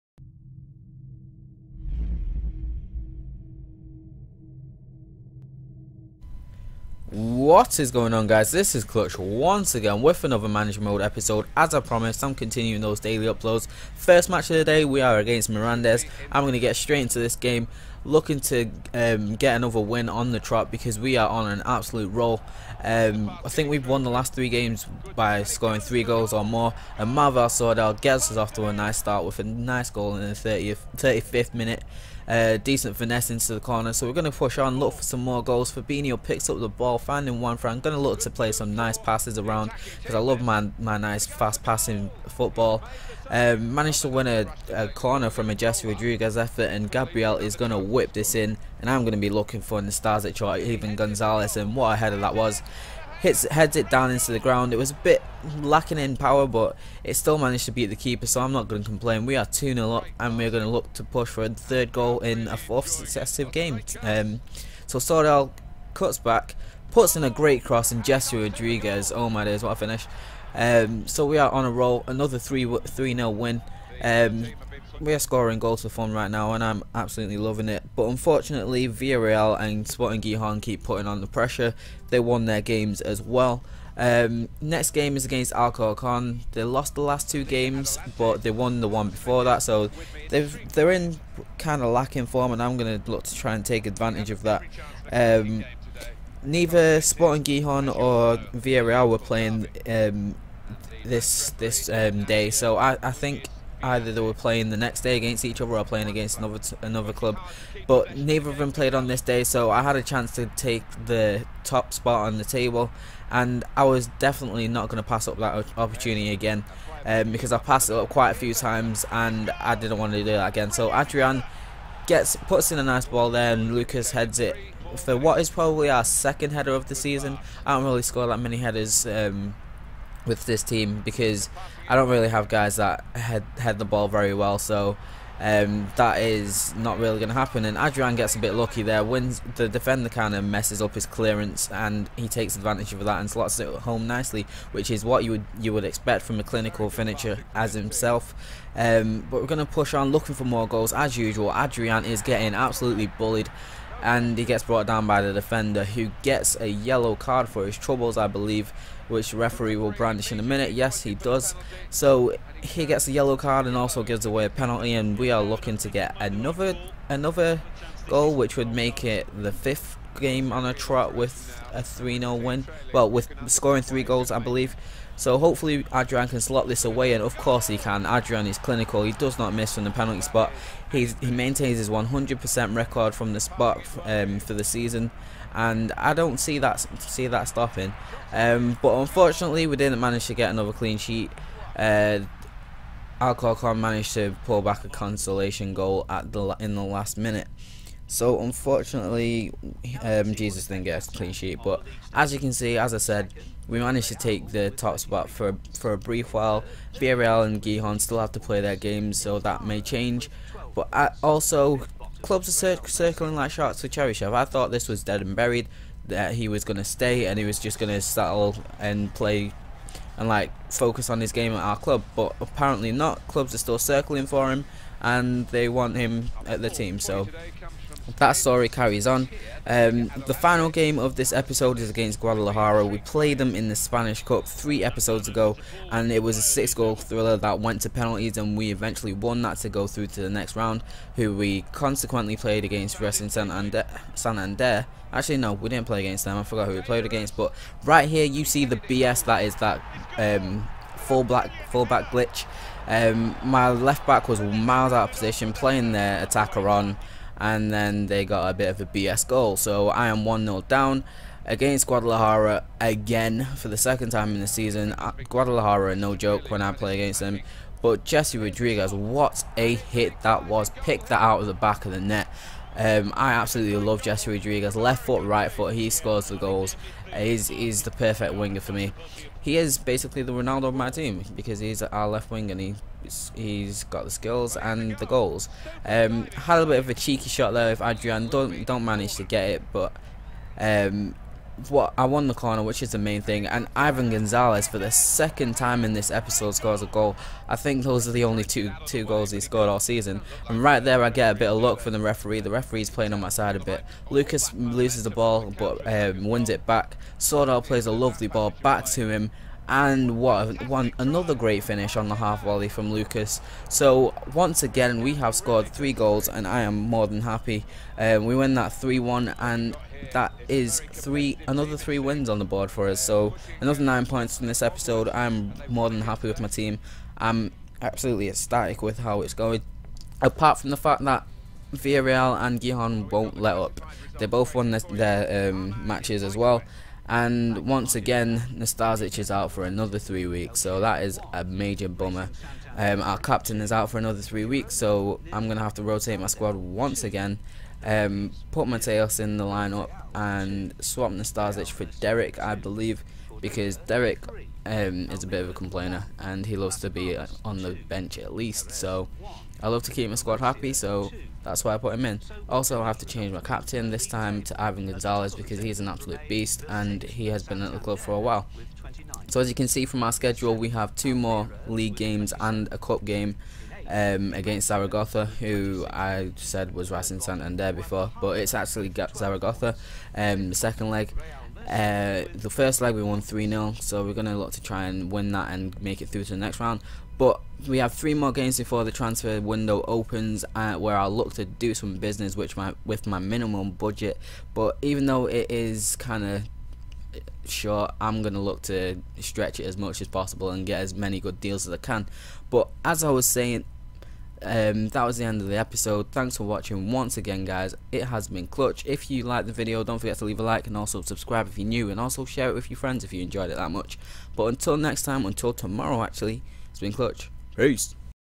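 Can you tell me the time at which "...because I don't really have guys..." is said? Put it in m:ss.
2:11.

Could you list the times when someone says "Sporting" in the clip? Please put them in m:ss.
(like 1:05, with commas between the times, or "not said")
1:19, 1:37.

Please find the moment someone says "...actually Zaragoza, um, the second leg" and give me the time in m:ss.
6:18.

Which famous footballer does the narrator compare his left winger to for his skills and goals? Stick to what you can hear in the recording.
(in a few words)
Ronaldo.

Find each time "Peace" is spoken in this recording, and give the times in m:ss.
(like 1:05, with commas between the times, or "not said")
6:57.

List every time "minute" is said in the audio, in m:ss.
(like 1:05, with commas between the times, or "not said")
0:31, 2:40, 3:17.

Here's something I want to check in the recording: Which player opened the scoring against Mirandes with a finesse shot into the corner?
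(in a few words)
Marvin Sordell.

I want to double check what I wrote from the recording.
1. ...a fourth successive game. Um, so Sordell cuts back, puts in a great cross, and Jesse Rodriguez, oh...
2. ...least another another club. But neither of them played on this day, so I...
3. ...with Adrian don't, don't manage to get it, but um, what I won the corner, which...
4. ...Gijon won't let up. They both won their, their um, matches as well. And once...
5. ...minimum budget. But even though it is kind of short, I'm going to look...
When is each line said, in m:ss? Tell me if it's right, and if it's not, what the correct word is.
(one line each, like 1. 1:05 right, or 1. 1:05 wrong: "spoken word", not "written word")
1. 1:02 right
2. 1:46 wrong: "against", not "least"
3. 4:47 right
4. 5:32 right
5. 6:33 right.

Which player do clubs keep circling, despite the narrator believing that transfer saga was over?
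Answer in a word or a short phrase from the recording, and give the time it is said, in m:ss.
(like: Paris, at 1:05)
Cheryshev, at 3:33.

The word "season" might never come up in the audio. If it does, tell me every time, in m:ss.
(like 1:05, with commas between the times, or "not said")
2:06, 3:04, 4:24, 4:59.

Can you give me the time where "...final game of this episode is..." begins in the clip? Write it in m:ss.
3:50.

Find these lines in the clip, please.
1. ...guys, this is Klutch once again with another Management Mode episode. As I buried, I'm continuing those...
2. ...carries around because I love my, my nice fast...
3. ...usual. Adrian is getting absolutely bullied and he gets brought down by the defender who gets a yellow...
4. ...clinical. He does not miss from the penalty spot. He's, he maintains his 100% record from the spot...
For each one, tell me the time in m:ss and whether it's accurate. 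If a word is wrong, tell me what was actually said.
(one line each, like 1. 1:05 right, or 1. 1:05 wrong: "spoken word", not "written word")
1. 0:08 wrong: "promised", not "buried"
2. 0:38 wrong: "passes", not "carries"
3. 2:31 right
4. 2:58 right.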